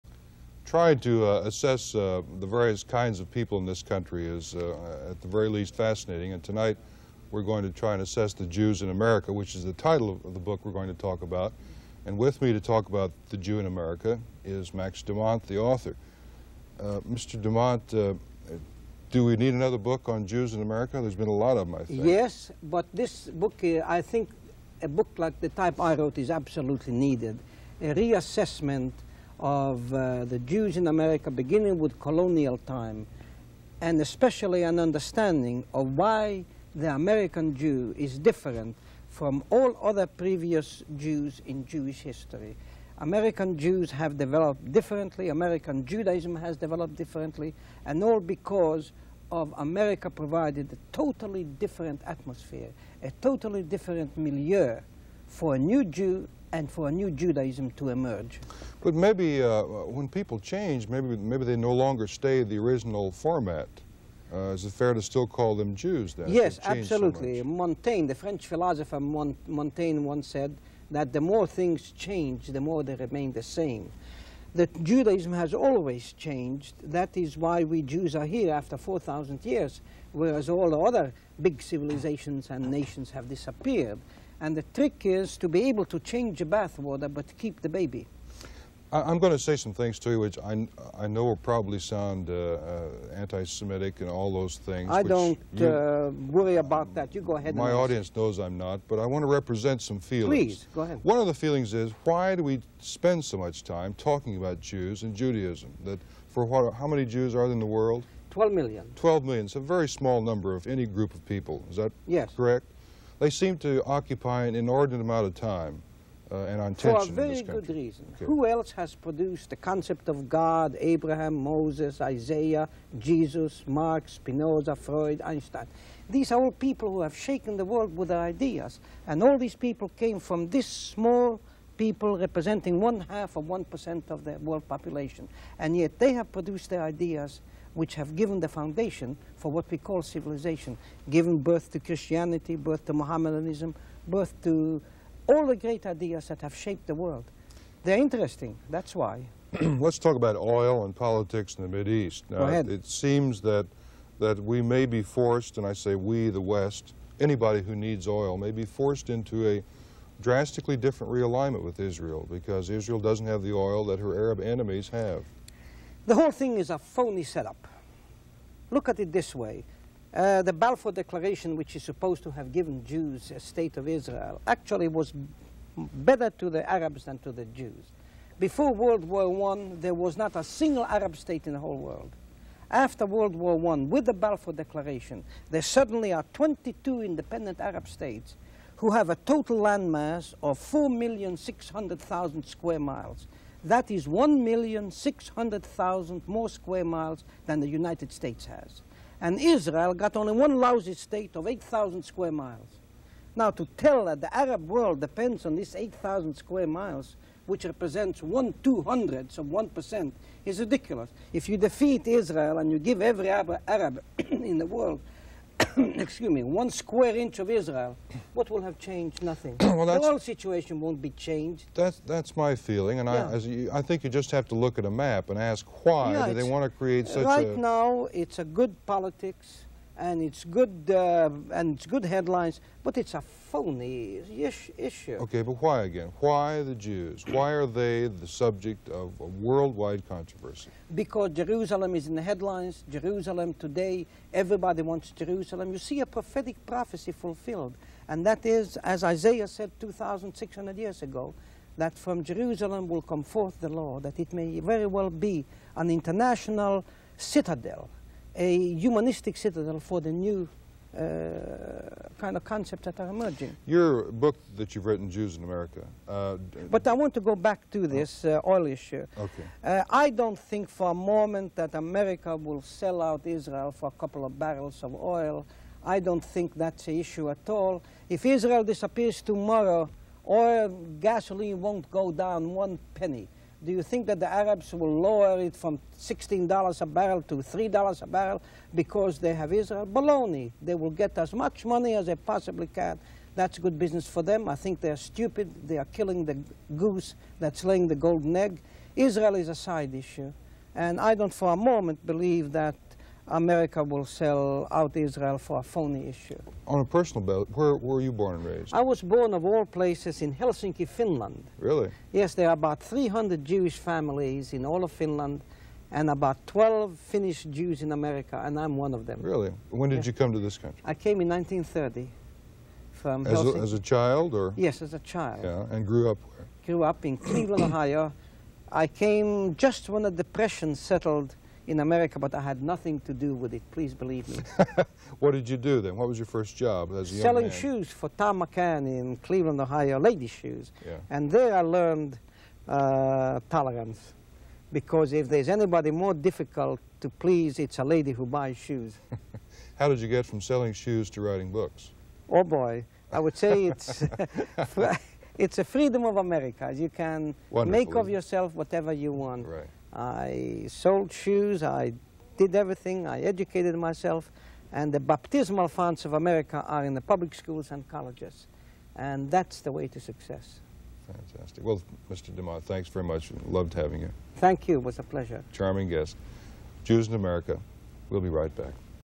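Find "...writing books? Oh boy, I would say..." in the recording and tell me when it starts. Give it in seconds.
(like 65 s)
351 s.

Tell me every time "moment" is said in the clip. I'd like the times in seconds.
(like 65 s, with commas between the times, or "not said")
270 s, 301 s.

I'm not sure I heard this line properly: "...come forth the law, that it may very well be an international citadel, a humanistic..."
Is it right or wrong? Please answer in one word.
right.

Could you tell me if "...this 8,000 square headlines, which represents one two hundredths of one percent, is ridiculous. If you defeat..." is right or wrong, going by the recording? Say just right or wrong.
wrong.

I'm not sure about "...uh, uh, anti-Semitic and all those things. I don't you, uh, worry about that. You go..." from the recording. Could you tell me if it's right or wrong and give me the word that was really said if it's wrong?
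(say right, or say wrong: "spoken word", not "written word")
right.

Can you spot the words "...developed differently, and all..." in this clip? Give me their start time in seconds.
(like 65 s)
46 s.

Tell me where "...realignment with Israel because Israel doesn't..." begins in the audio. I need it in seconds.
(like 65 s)
161 s.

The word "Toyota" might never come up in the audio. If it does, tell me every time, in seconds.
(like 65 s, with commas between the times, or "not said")
not said.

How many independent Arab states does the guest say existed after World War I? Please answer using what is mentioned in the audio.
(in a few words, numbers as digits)
22.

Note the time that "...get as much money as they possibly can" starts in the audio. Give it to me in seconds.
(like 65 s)
290 s.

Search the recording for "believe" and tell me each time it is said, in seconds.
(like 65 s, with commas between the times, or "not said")
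302 s, 333 s.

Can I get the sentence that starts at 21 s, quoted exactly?
There's been a lot of them, I think.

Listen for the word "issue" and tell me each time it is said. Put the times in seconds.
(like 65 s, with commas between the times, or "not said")
234 s, 268 s, 276 s, 299 s, 306 s.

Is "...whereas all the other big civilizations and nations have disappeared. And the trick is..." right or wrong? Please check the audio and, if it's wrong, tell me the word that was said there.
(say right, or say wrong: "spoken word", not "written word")
right.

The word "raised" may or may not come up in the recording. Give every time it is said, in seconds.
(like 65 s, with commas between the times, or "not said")
308 s.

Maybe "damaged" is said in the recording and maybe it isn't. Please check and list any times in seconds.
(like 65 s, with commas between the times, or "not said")
not said.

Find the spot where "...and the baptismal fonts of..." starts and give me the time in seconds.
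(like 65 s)
364 s.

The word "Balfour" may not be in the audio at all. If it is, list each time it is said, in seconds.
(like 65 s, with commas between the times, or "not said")
170 s, 184 s.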